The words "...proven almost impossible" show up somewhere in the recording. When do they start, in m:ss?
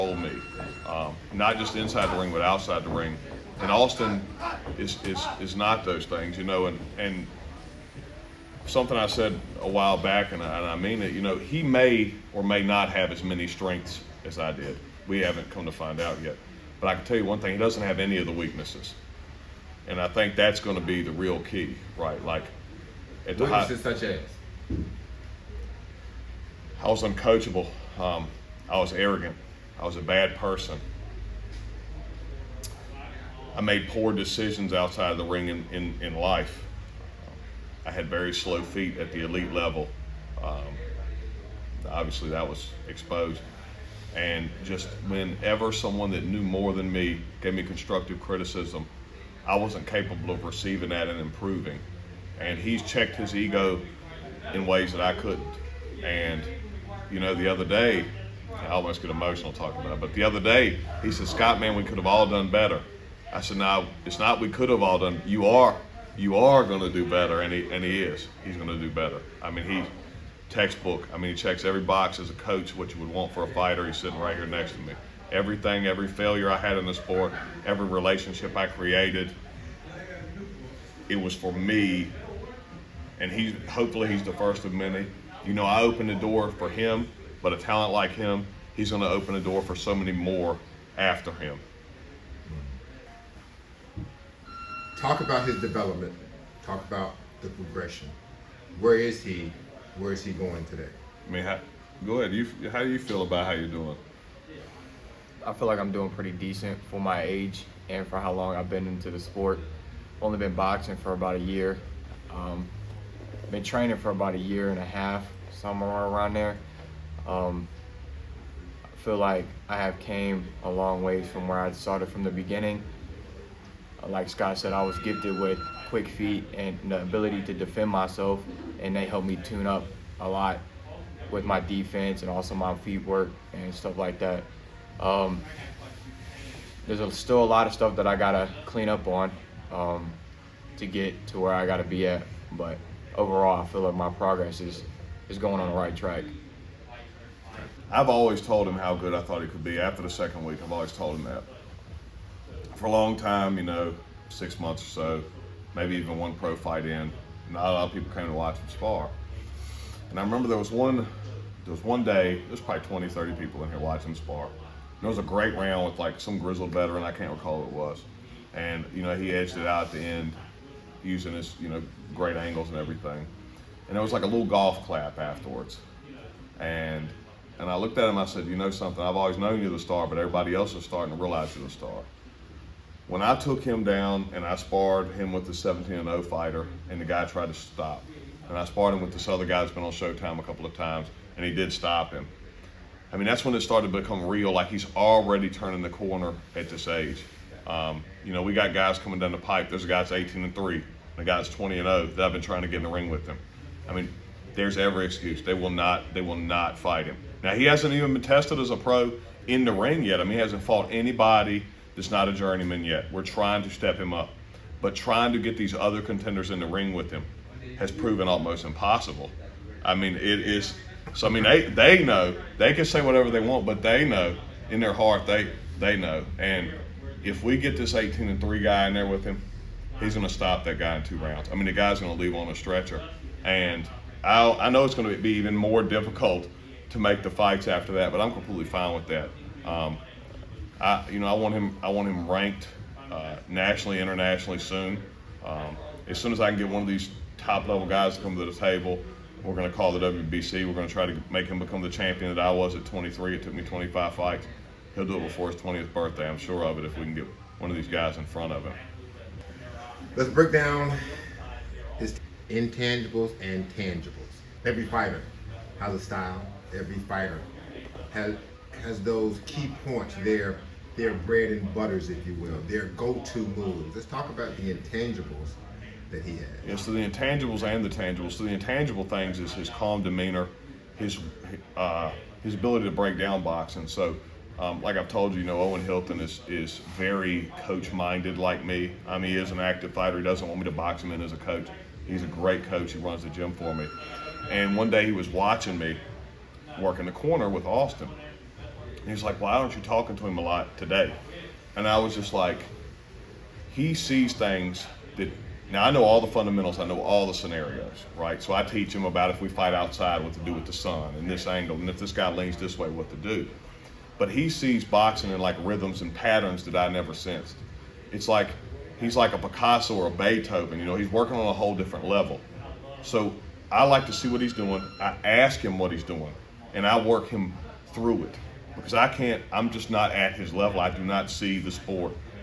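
3:37.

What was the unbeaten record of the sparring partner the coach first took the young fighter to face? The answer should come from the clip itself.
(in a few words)
17-0.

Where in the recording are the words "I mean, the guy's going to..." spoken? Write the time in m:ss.
3:51.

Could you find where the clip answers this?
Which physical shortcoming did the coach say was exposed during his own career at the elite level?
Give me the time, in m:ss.
0:38.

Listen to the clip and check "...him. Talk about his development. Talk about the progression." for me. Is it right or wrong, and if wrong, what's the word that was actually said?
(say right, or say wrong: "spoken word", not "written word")
right.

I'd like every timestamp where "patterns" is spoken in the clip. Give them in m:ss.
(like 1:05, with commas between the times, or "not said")
5:16.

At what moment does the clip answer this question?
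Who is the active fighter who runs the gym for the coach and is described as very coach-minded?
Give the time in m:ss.
4:45.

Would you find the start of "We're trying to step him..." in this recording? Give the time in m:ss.
3:33.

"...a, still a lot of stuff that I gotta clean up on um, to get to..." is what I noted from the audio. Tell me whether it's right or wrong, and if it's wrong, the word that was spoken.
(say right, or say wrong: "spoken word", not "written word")
right.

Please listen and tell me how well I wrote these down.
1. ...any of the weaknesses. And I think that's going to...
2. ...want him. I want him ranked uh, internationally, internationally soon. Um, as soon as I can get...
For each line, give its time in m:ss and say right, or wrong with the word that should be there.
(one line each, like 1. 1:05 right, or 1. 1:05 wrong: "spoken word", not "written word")
1. 0:17 right
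2. 4:01 wrong: "nationally", not "internationally".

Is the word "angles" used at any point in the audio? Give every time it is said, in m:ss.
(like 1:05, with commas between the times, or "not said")
2:52, 5:11.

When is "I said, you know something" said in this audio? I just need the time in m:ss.
2:58.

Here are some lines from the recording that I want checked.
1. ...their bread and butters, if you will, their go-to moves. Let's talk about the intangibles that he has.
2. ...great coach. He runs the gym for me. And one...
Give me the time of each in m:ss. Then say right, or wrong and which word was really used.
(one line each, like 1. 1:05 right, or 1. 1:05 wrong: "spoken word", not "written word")
1. 4:30 right
2. 4:52 right.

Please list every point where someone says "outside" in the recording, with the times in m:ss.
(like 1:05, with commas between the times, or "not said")
0:02, 0:34, 5:09.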